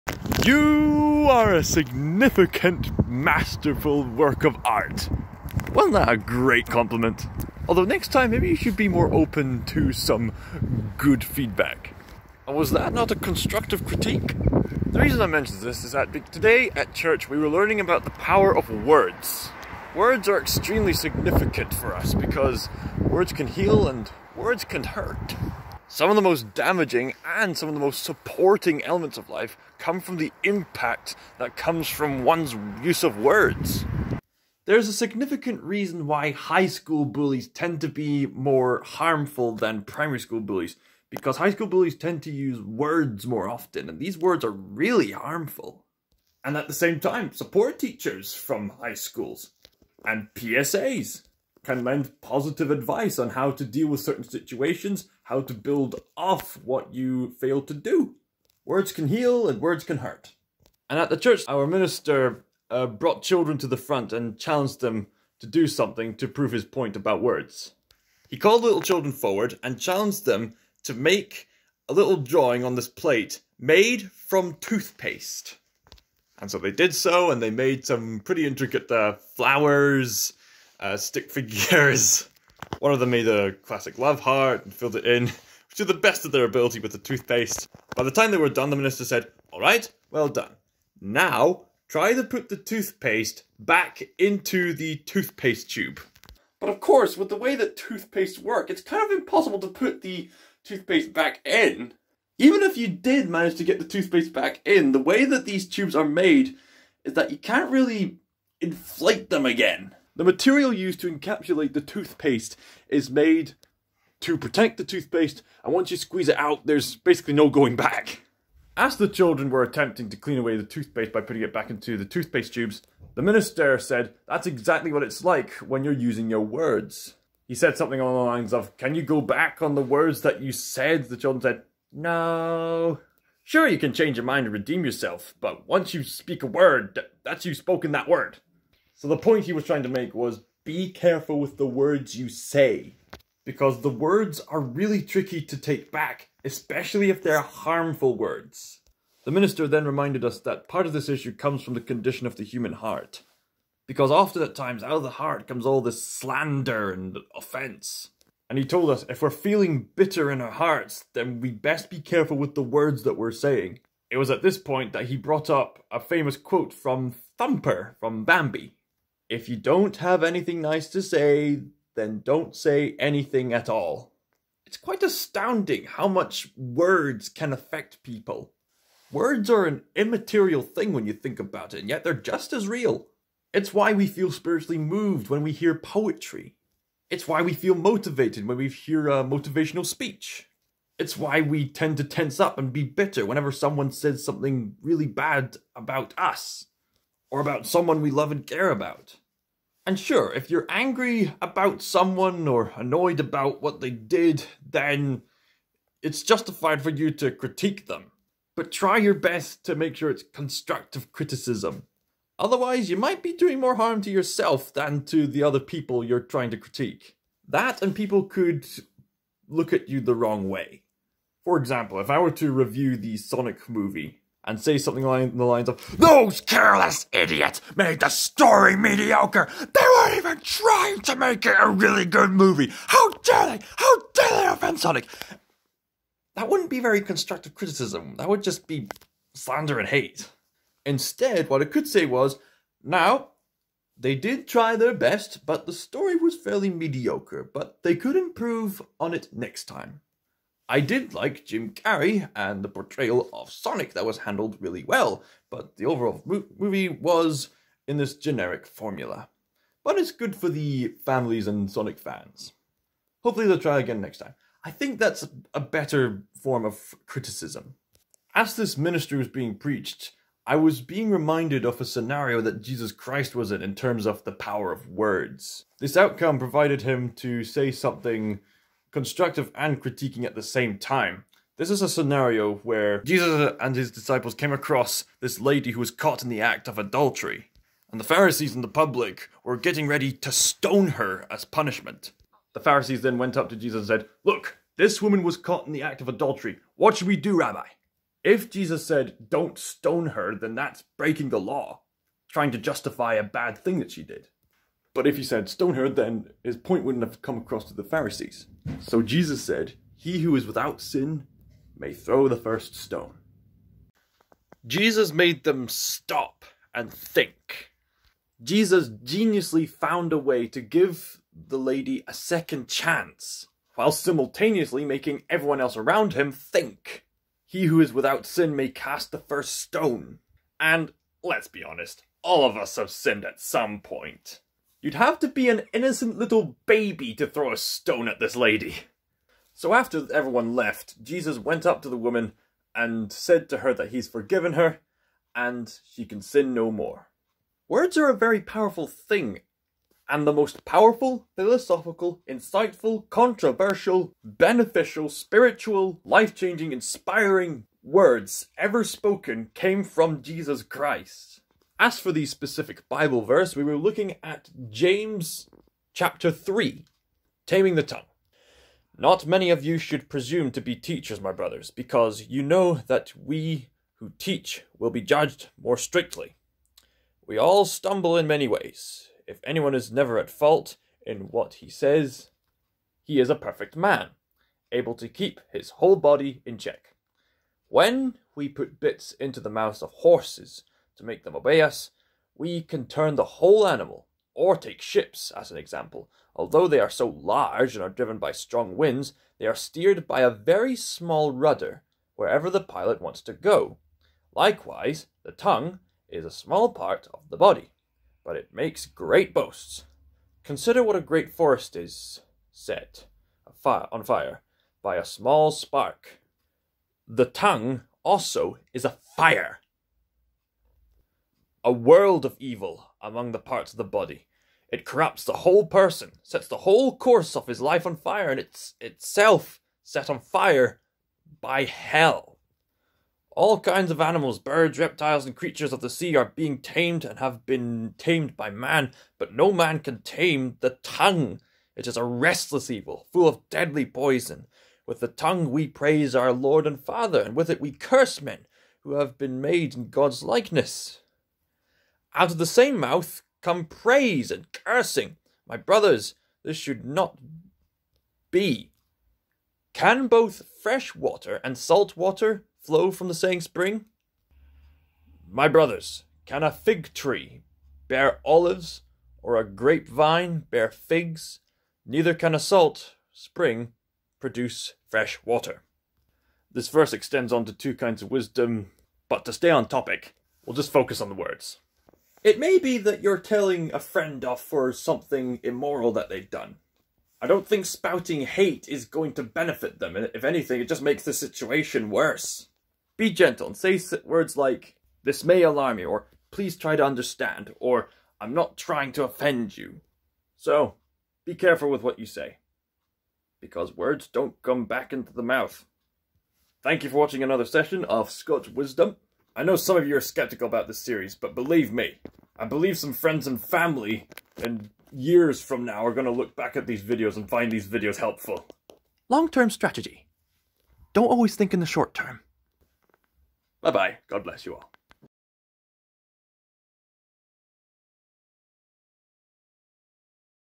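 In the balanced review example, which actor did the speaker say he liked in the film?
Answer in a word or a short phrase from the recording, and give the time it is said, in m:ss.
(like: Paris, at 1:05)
Jim Carrey, at 4:11.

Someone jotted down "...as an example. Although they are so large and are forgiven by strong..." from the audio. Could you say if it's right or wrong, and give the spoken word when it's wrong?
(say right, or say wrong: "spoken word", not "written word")
wrong: "driven", not "forgiven".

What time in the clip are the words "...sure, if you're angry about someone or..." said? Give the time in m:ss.
3:19.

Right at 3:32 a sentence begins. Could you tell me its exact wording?
Otherwise, you might be doing more harm to yourself than to the other people you're trying to critique.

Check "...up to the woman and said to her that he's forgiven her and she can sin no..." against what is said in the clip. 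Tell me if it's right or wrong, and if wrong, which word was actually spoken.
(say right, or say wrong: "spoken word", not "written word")
right.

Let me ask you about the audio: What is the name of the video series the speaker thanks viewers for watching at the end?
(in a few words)
ScotsWisdom.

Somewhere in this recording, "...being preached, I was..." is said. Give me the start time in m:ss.
4:29.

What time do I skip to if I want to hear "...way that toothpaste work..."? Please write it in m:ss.
1:37.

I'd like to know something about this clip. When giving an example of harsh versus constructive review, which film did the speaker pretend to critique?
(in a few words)
The Sonic movie.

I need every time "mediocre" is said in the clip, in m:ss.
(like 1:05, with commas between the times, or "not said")
3:48, 4:06.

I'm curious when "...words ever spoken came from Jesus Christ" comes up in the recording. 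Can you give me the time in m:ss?
5:57.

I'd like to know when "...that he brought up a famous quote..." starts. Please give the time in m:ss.
2:44.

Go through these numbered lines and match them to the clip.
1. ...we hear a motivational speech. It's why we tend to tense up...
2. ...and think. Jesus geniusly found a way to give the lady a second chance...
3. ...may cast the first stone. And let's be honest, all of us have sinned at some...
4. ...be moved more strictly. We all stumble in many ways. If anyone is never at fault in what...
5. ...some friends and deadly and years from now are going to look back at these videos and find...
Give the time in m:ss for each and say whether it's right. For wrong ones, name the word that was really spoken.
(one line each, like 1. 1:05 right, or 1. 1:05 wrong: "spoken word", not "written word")
1. 3:08 right
2. 5:16 right
3. 5:28 right
4. 6:14 wrong: "judged", not "moved"
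5. 8:32 wrong: "family", not "deadly".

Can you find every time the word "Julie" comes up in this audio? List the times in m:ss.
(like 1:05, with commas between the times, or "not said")
not said.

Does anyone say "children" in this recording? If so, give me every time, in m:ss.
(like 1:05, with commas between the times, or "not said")
1:03, 1:08, 1:59, 2:11.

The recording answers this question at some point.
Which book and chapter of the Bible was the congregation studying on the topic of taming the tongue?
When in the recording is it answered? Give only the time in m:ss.
6:04.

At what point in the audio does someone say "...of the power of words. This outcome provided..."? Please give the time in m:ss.
4:34.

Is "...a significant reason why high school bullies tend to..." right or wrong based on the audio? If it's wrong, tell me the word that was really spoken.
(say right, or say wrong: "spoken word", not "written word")
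right.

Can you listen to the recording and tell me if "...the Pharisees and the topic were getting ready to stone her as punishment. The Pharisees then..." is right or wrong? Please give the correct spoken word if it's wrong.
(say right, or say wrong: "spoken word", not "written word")
wrong: "public", not "topic".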